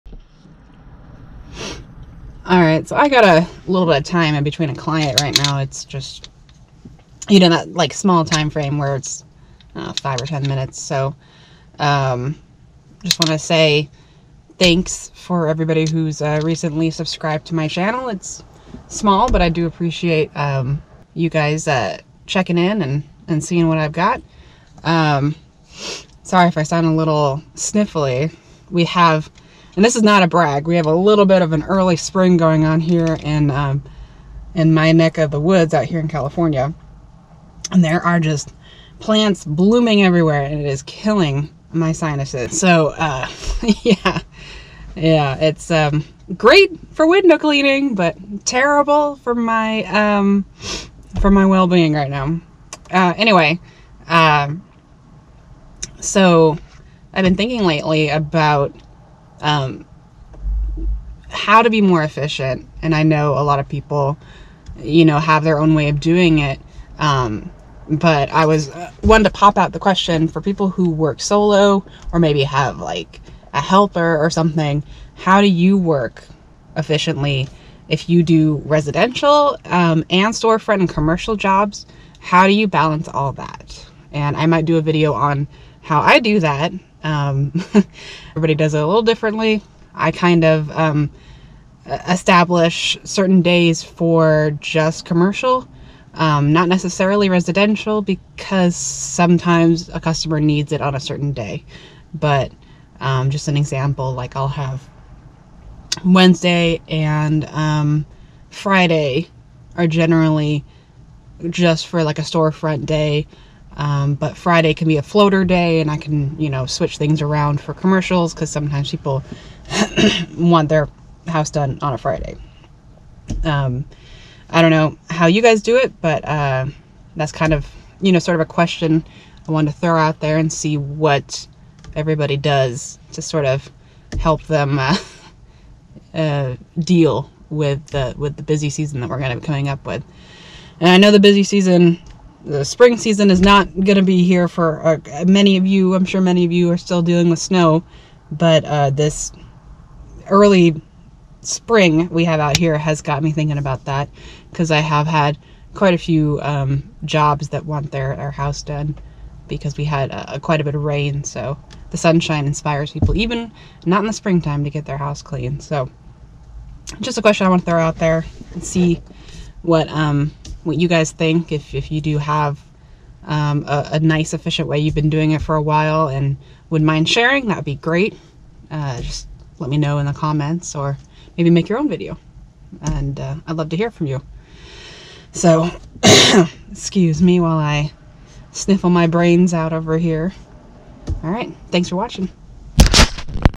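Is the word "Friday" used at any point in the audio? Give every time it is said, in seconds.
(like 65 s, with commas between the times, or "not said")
108 s, 114 s, 121 s.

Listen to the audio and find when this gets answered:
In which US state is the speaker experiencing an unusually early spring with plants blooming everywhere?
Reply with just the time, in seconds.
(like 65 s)
36 s.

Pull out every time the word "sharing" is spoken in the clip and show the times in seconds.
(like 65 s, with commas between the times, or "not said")
177 s.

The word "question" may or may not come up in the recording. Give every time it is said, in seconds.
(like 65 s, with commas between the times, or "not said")
69 s, 128 s, 167 s.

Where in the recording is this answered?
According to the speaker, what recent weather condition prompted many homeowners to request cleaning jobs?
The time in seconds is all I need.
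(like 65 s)
160 s.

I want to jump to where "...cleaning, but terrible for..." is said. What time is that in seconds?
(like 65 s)
47 s.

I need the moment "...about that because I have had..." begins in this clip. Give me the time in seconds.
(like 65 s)
153 s.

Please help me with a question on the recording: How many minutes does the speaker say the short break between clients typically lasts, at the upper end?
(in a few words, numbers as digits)
10.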